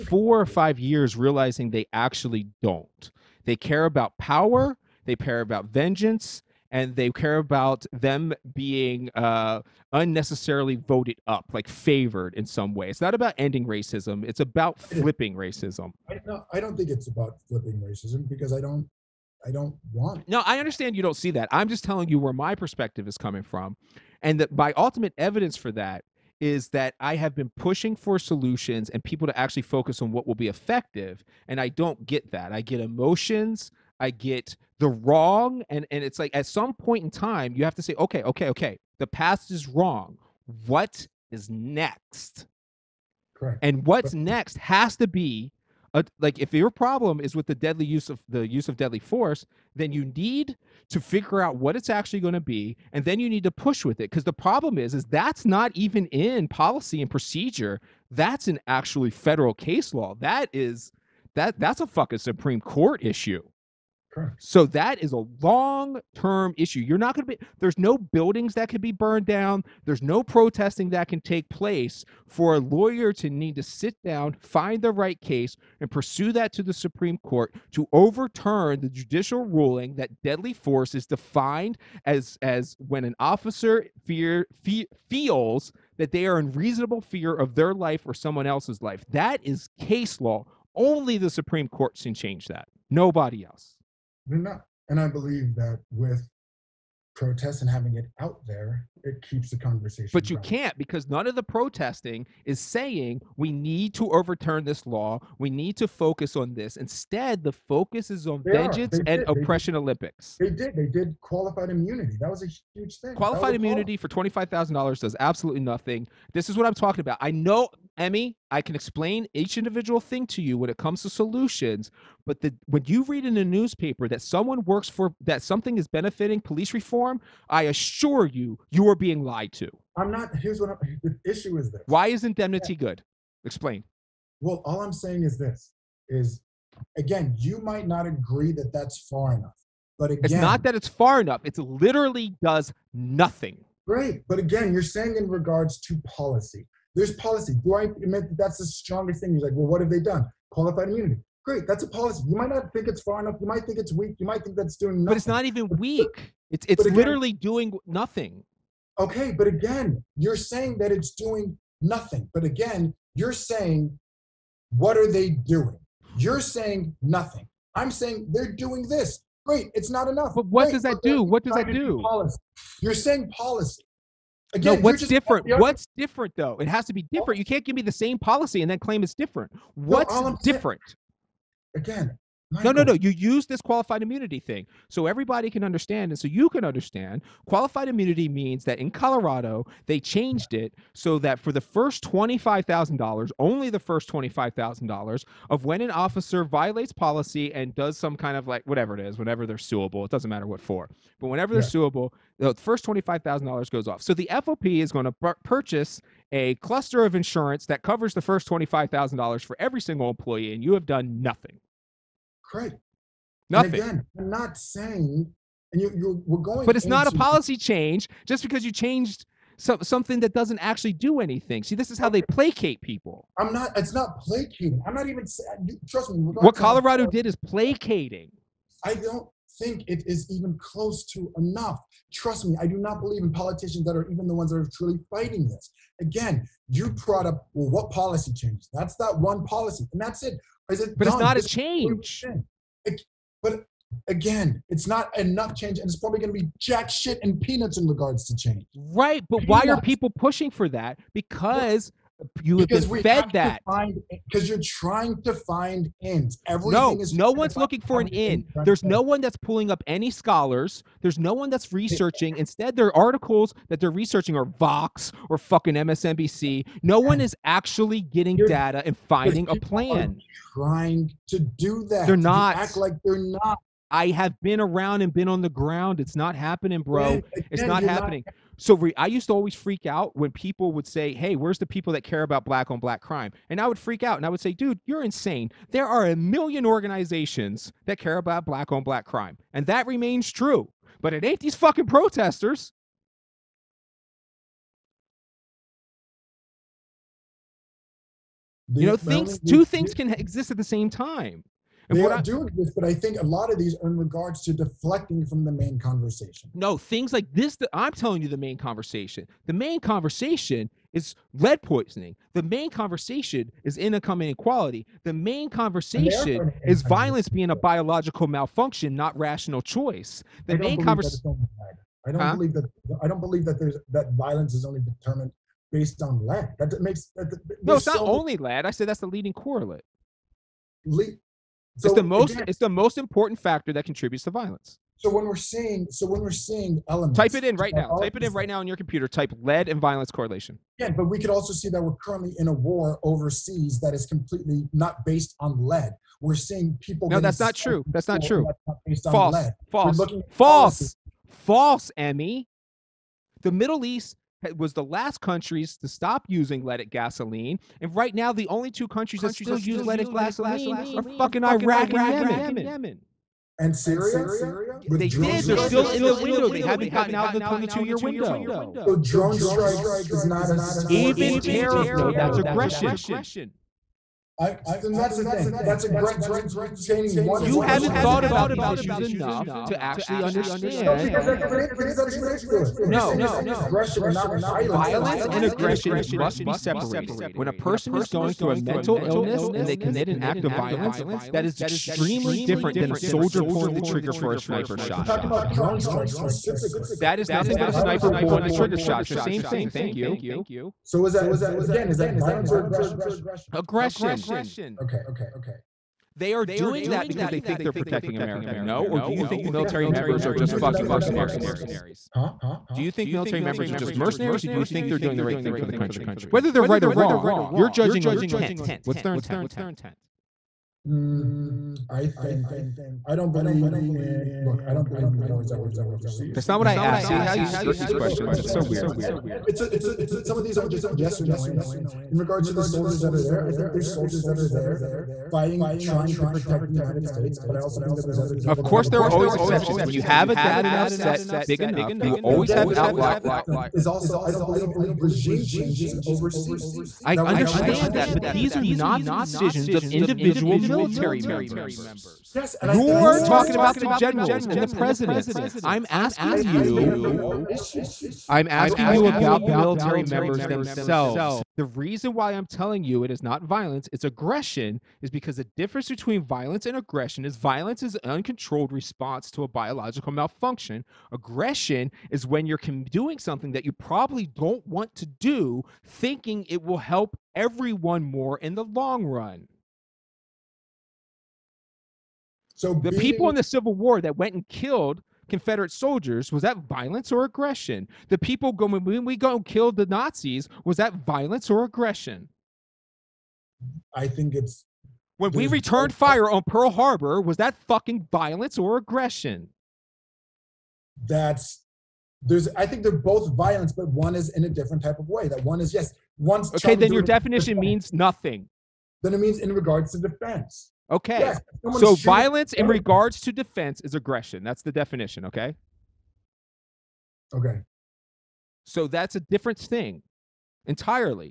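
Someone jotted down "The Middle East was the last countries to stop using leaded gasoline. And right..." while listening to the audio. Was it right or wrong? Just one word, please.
right.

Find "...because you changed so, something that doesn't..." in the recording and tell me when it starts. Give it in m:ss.
3:38.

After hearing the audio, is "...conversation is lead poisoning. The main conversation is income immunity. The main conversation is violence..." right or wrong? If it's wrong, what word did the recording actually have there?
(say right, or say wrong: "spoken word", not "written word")
wrong: "inequality", not "immunity".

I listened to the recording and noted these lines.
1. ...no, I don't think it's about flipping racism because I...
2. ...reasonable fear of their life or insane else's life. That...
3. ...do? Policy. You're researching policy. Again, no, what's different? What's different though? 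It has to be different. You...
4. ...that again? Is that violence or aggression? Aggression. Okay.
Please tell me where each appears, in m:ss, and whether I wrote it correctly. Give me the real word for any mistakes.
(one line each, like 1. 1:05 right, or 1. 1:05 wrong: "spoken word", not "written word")
1. 0:16 right
2. 1:26 wrong: "someone", not "insane"
3. 2:51 wrong: "saying", not "researching"
4. 6:41 right.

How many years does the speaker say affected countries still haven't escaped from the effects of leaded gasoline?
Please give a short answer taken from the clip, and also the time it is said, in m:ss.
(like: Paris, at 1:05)
22, at 6:07.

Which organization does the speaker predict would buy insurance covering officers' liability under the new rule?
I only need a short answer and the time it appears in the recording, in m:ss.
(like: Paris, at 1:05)
FOP, at 3:24.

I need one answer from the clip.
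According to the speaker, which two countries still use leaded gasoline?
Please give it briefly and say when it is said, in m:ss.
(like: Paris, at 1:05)
Iraq and Yemen, at 6:01.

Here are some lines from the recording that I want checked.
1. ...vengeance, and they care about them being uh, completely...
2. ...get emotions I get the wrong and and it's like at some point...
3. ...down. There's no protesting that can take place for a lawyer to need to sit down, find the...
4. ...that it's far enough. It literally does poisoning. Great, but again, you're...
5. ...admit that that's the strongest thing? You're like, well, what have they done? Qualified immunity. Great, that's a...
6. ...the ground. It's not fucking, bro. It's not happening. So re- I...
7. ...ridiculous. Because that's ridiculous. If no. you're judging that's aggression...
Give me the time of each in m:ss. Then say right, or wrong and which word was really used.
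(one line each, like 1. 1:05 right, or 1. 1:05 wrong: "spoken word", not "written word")
1. 0:05 wrong: "unnecessarily", not "completely"
2. 0:32 right
3. 1:09 right
4. 2:20 wrong: "nothing", not "poisoning"
5. 2:27 right
6. 4:35 wrong: "happening", not "fucking"
7. 6:21 wrong: "saying", not "judging".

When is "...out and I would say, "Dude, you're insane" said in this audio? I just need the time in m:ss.
4:44.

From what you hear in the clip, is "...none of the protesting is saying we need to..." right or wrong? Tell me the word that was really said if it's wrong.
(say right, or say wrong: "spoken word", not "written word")
right.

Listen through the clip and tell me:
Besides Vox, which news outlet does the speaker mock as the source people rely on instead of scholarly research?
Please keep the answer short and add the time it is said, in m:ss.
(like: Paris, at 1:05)
MSNBC, at 4:25.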